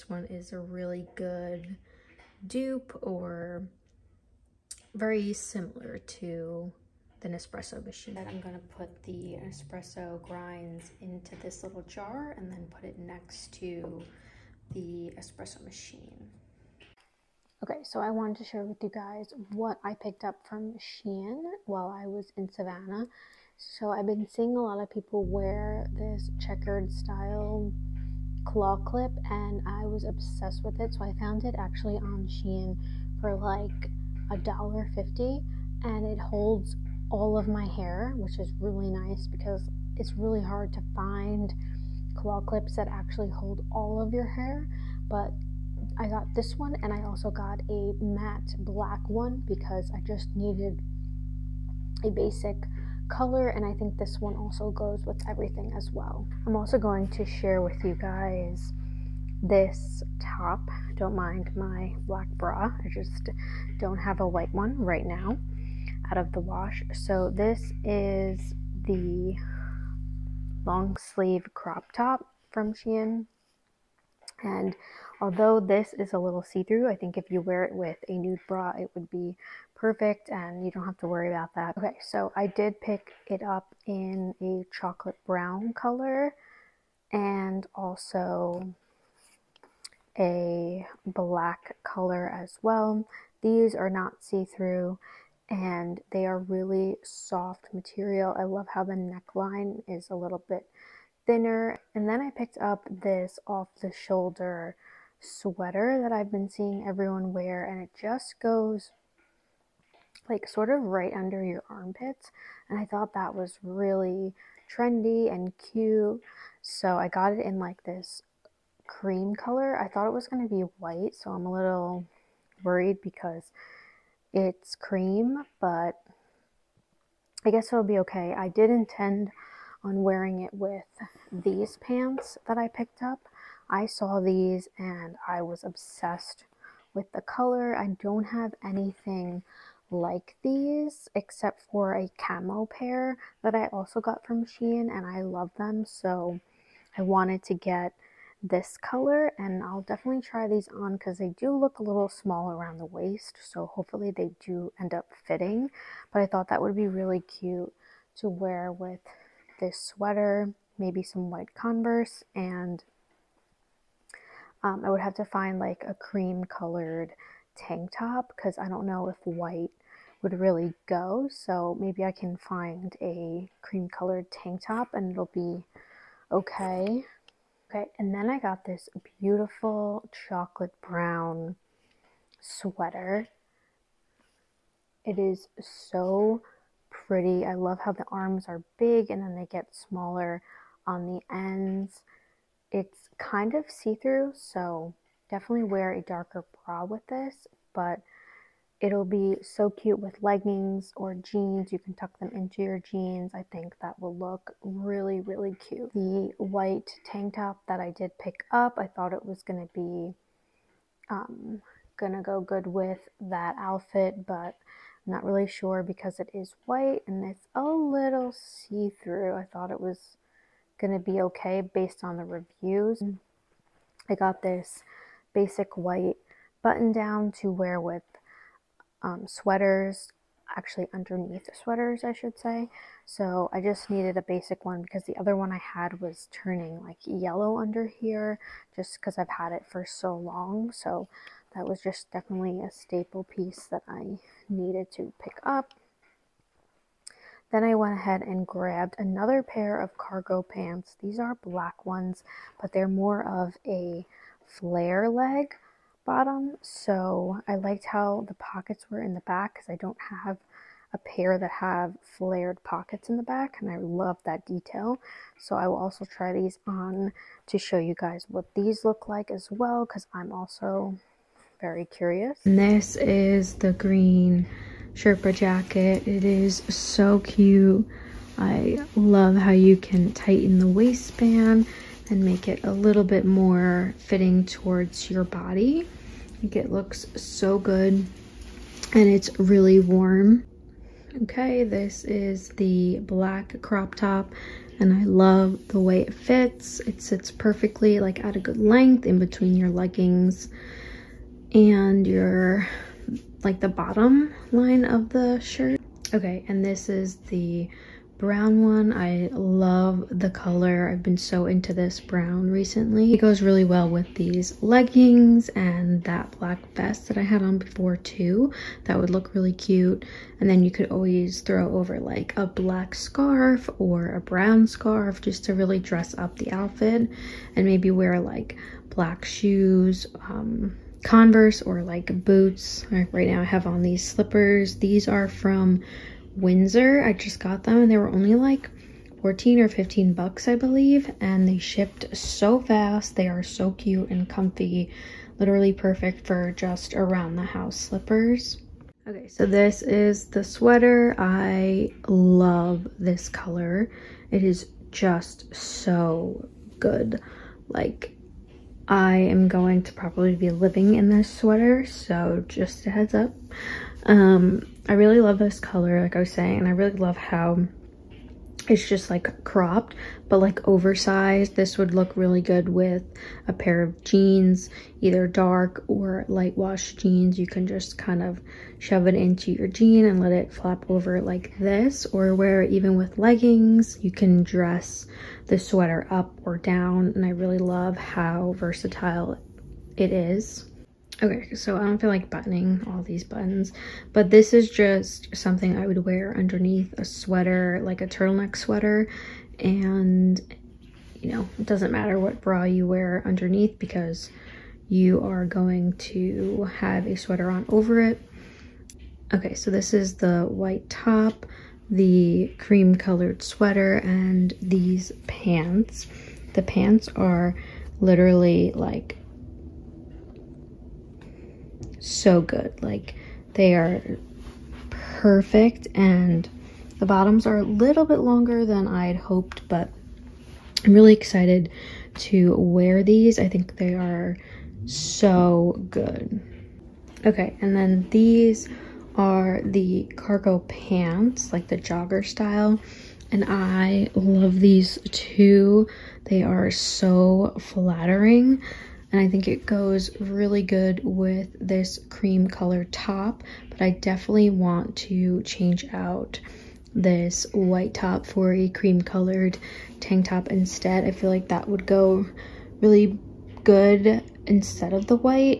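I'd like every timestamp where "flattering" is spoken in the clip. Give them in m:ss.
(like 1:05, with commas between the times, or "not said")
7:27.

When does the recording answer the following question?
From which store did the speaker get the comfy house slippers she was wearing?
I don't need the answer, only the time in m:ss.
5:36.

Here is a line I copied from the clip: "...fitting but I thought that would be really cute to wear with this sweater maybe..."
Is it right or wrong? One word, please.
right.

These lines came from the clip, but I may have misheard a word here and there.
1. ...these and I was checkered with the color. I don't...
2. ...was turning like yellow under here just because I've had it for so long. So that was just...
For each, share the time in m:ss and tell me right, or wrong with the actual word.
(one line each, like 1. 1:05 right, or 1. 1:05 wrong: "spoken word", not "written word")
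1. 2:14 wrong: "obsessed", not "checkered"
2. 3:55 right.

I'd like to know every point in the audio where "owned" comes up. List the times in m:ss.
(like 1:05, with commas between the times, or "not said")
not said.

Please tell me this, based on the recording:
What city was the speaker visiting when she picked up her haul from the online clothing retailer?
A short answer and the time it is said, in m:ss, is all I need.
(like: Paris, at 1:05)
Savannah, at 0:22.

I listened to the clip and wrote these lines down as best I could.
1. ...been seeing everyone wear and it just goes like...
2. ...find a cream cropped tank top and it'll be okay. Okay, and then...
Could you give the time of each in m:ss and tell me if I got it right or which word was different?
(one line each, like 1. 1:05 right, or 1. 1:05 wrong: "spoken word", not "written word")
1. 1:46 right
2. 2:52 wrong: "colored", not "cropped".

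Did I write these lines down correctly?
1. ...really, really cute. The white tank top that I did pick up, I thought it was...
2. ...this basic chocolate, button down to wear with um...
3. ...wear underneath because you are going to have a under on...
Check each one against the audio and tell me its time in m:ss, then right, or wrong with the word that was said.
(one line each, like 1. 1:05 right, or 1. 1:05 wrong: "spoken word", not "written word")
1. 3:24 right
2. 3:44 wrong: "white", not "chocolate"
3. 6:42 wrong: "sweater", not "under".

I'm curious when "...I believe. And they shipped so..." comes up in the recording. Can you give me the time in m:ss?
5:40.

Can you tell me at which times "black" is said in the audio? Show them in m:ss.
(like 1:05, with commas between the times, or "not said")
0:48, 1:02, 1:31, 4:11, 4:52, 5:16, 5:22, 5:28.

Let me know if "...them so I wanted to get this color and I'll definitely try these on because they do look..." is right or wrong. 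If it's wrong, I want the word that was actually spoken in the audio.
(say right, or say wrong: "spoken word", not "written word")
right.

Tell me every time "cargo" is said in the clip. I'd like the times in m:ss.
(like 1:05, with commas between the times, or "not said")
4:09, 7:20.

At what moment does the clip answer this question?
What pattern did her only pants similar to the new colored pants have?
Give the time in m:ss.
2:22.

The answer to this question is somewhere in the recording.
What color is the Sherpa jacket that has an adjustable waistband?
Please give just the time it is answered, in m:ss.
4:33.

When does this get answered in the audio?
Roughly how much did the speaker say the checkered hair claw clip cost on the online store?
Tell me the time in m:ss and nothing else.
0:34.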